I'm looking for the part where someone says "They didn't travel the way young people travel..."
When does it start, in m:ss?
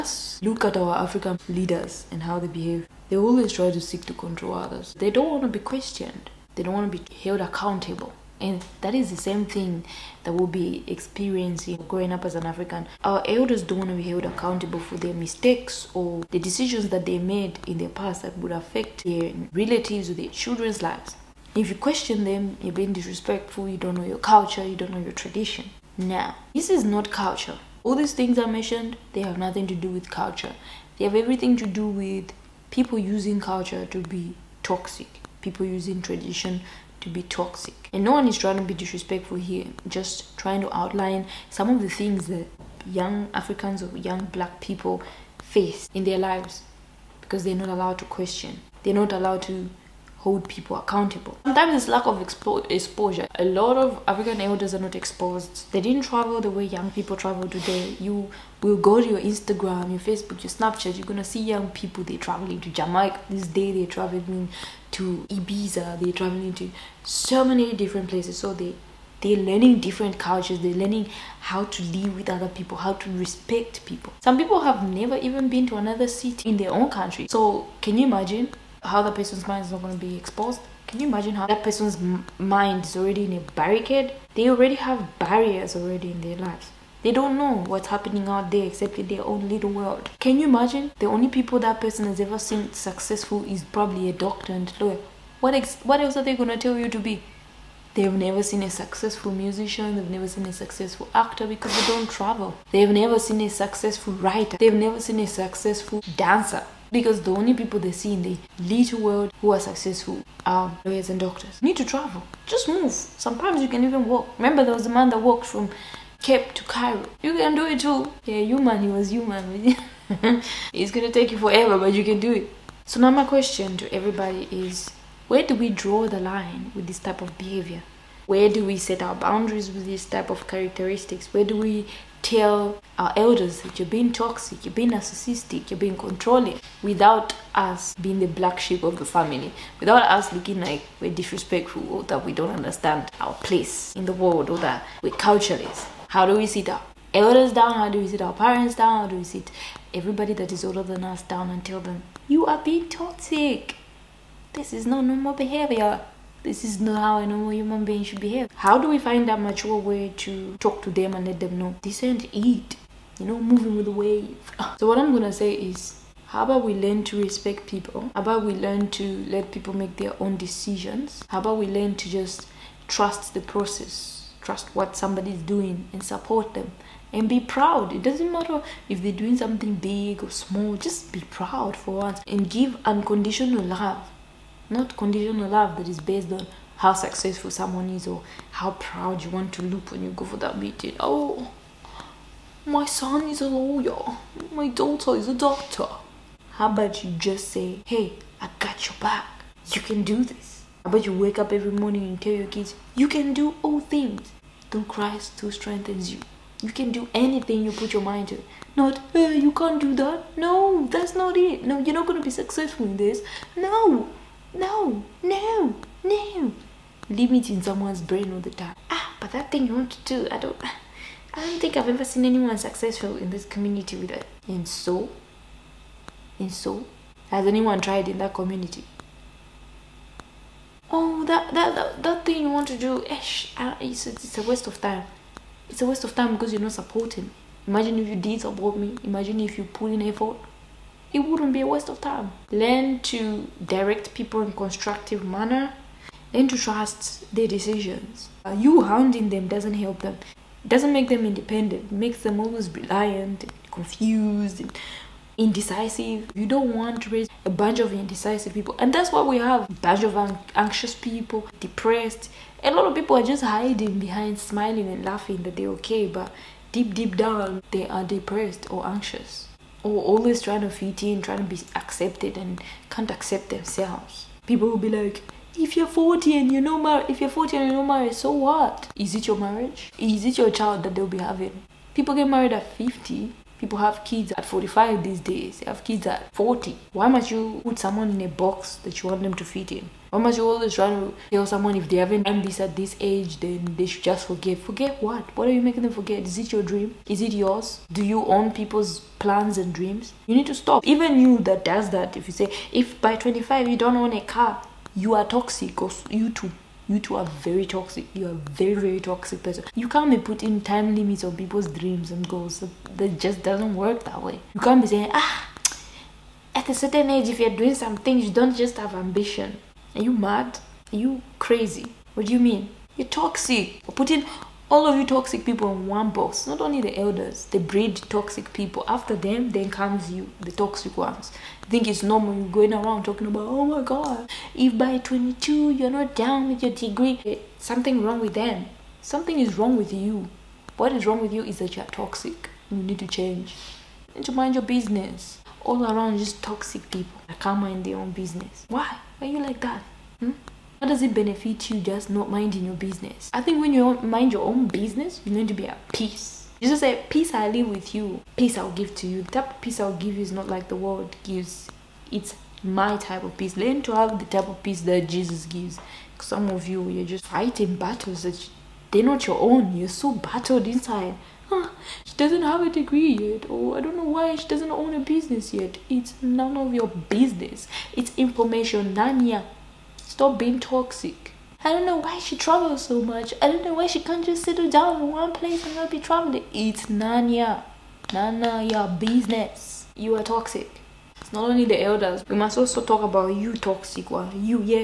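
0:55.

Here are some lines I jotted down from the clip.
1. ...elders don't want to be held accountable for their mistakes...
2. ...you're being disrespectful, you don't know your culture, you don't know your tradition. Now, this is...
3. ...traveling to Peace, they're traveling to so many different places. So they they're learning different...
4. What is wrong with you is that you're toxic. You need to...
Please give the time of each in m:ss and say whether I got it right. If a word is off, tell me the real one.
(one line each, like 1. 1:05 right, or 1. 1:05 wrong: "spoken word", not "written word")
1. 0:13 right
2. 0:22 right
3. 1:03 wrong: "Ibiza", not "Peace"
4. 5:40 right.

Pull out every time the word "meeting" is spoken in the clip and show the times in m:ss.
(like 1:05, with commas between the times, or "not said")
3:10.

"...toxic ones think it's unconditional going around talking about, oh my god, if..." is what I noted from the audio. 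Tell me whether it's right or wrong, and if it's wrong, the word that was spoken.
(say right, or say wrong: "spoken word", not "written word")
wrong: "normal", not "unconditional".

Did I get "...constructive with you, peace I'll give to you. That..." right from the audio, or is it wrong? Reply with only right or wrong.
wrong.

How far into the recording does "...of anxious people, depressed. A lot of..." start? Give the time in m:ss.
4:20.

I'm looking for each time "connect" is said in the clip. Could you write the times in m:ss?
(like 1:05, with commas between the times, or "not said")
not said.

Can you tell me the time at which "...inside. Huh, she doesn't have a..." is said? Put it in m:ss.
6:10.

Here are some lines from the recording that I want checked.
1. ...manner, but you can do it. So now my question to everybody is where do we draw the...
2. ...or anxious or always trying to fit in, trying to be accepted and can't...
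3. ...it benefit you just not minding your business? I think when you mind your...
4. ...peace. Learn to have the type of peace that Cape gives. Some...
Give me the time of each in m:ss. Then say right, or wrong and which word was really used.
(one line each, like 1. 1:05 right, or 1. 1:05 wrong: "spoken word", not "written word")
1. 2:01 wrong: "forever", not "manner"
2. 4:28 right
3. 5:51 right
4. 6:03 wrong: "Jesus", not "Cape".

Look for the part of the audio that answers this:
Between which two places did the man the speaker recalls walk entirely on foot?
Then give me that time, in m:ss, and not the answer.
1:56.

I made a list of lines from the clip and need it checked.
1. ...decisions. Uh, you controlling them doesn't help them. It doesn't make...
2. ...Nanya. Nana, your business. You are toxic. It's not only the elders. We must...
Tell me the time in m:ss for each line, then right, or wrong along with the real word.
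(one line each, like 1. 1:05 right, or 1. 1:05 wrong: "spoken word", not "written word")
1. 4:07 wrong: "hounding", not "controlling"
2. 6:26 right.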